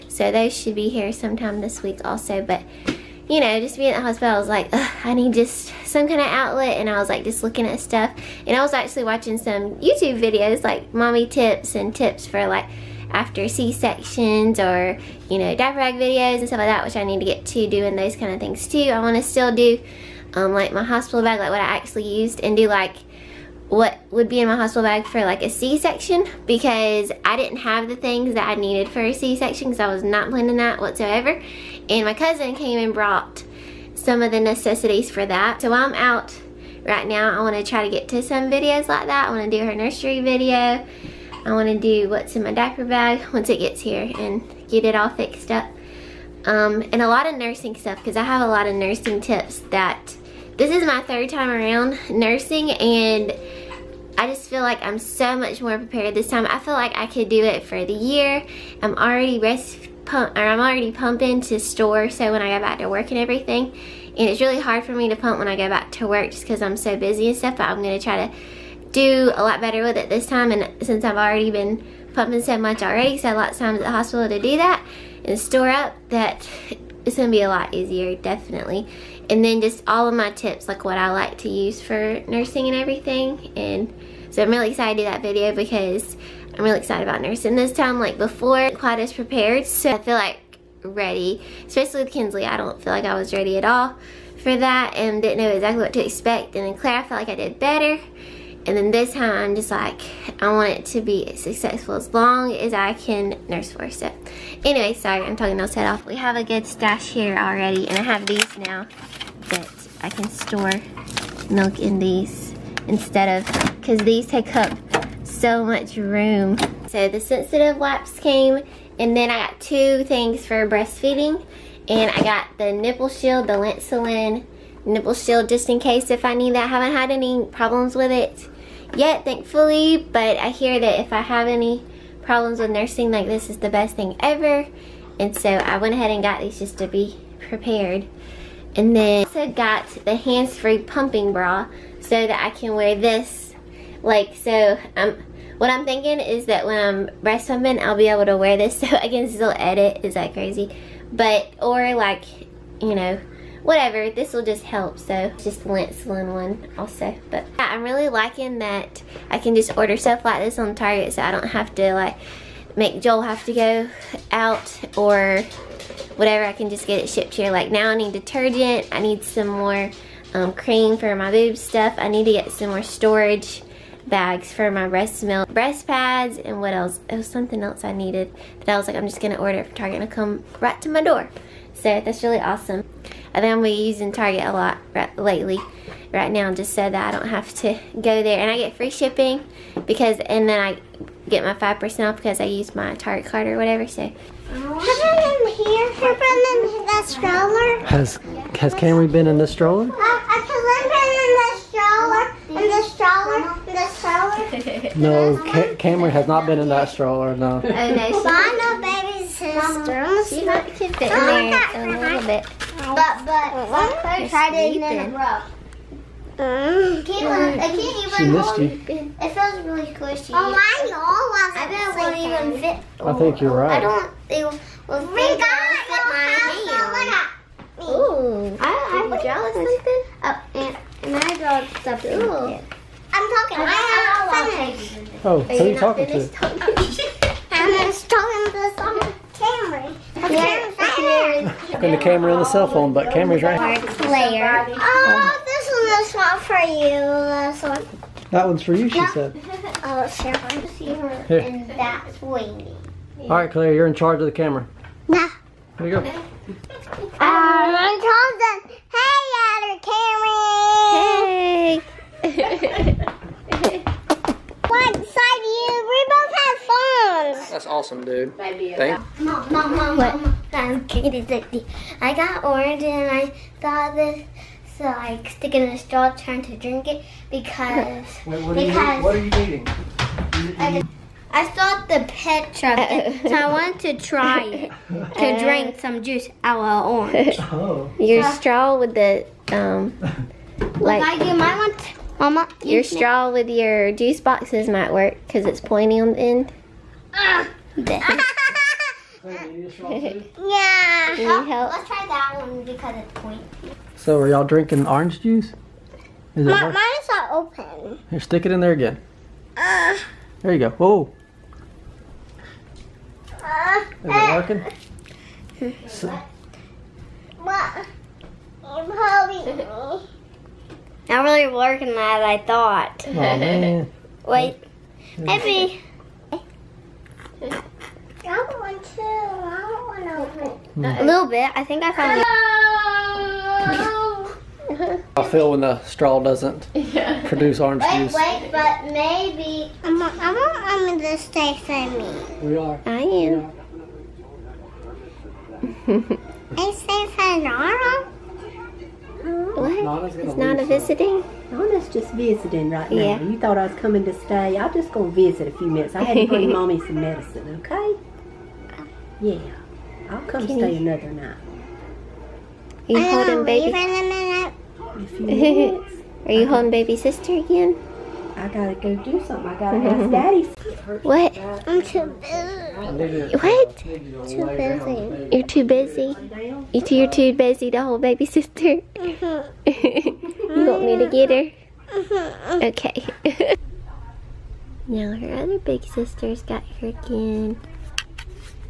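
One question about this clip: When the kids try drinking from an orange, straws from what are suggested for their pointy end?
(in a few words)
Juice boxes.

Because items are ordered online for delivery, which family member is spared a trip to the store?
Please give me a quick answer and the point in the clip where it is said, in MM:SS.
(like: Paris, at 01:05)
Joel, at 02:43.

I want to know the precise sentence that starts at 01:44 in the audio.
Anyway, sorry, I'm talking those head off.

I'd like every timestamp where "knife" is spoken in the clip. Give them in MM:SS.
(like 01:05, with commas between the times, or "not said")
not said.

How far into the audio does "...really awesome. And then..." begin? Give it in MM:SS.
03:02.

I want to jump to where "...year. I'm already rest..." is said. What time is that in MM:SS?
00:57.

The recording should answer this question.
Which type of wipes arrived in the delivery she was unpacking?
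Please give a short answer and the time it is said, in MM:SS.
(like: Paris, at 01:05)
Sensitive wipes, at 01:57.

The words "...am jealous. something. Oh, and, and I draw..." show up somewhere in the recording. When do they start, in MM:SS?
03:49.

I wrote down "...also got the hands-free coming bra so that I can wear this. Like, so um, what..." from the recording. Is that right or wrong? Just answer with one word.
wrong.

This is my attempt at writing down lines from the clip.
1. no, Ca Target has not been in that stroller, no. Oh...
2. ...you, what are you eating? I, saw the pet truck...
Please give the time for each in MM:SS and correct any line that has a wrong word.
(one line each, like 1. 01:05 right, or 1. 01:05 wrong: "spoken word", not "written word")
1. 03:24 wrong: "Camry", not "Target"
2. 04:38 right.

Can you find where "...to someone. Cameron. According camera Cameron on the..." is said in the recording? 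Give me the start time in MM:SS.
03:58.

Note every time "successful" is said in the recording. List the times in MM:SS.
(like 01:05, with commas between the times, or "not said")
01:41.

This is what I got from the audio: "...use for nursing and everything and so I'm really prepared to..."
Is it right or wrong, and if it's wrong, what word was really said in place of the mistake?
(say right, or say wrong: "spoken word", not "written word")
wrong: "excited", not "prepared".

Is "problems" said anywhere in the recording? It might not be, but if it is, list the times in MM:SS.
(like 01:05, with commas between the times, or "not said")
02:07, 02:12.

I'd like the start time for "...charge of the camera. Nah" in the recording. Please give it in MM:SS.
04:13.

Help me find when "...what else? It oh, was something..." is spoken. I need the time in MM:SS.
02:56.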